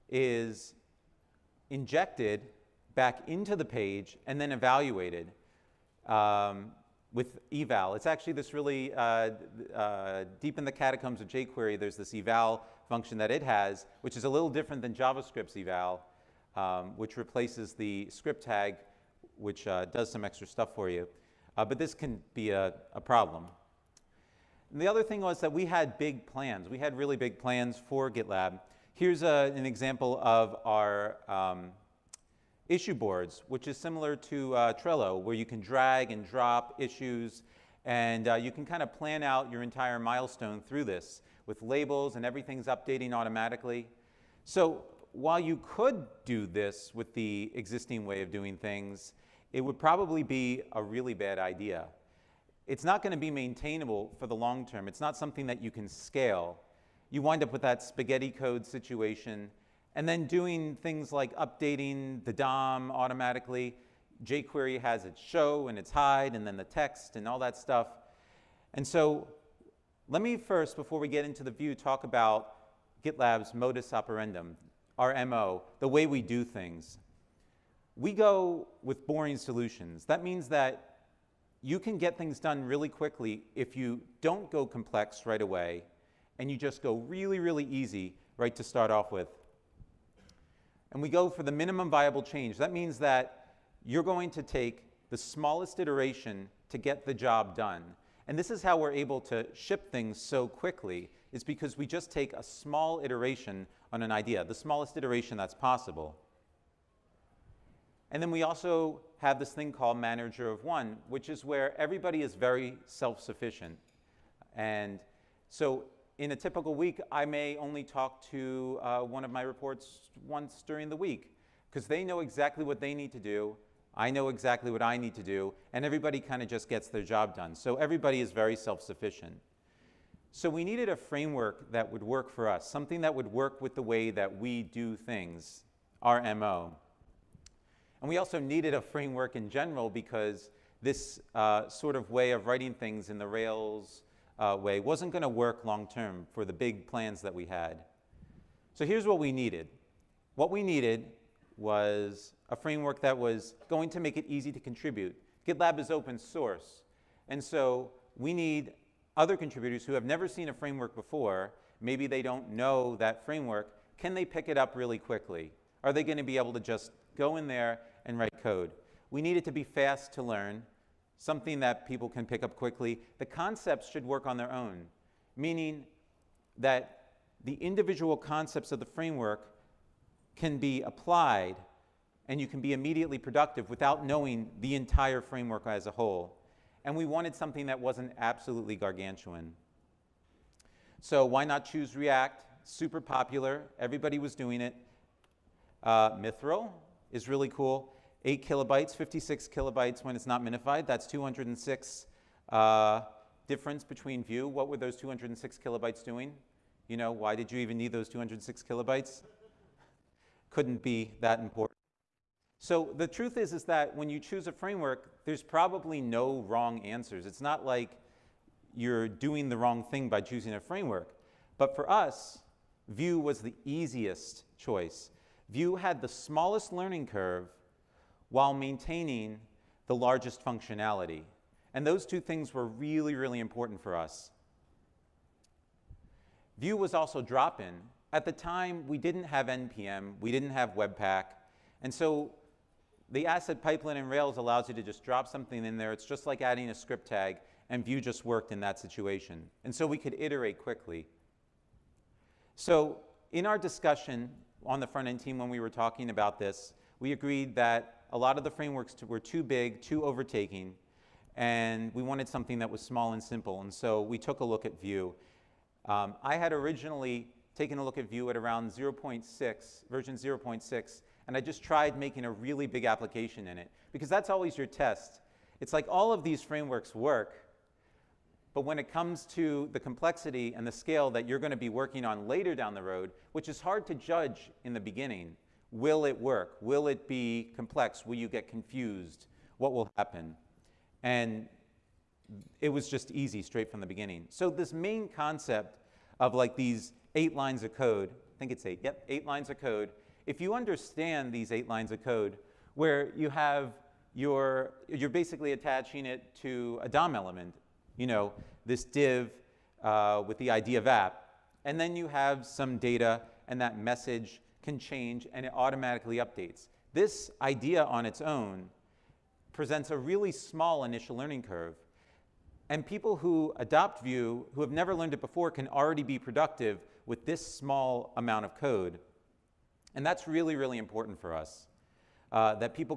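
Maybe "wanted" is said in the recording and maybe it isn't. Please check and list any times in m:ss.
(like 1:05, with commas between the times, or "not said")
3:07, 4:22.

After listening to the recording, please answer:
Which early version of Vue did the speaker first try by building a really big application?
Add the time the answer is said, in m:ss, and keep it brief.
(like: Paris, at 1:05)
0.6, at 4:29.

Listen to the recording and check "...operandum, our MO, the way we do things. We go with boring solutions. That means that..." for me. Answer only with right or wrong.
right.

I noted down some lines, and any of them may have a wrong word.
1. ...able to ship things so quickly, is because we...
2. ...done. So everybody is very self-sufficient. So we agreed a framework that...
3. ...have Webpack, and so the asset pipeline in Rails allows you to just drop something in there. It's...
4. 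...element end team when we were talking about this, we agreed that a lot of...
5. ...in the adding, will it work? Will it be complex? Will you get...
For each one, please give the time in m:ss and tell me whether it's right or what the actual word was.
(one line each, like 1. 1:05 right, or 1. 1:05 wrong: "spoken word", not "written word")
1. 1:38 right
2. 2:07 wrong: "needed", not "agreed"
3. 4:00 right
4. 4:14 wrong: "front", not "element"
5. 4:44 wrong: "beginning", not "adding".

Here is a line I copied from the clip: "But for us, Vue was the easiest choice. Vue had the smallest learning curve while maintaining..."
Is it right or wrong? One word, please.
right.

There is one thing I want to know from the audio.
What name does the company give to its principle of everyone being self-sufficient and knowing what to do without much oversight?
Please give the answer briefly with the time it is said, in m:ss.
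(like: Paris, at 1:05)
manager of one, at 1:49.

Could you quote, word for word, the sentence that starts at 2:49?
We need it to be fast to learn, something that people can pick up quickly.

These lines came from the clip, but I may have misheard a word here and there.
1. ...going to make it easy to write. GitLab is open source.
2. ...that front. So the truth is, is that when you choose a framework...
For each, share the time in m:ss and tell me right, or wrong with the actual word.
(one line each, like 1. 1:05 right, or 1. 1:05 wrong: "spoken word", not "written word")
1. 2:33 wrong: "contribute", not "write"
2. 3:31 wrong: "important", not "front".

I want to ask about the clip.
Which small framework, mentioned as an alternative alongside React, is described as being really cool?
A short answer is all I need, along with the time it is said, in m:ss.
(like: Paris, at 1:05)
Mithril, at 3:16.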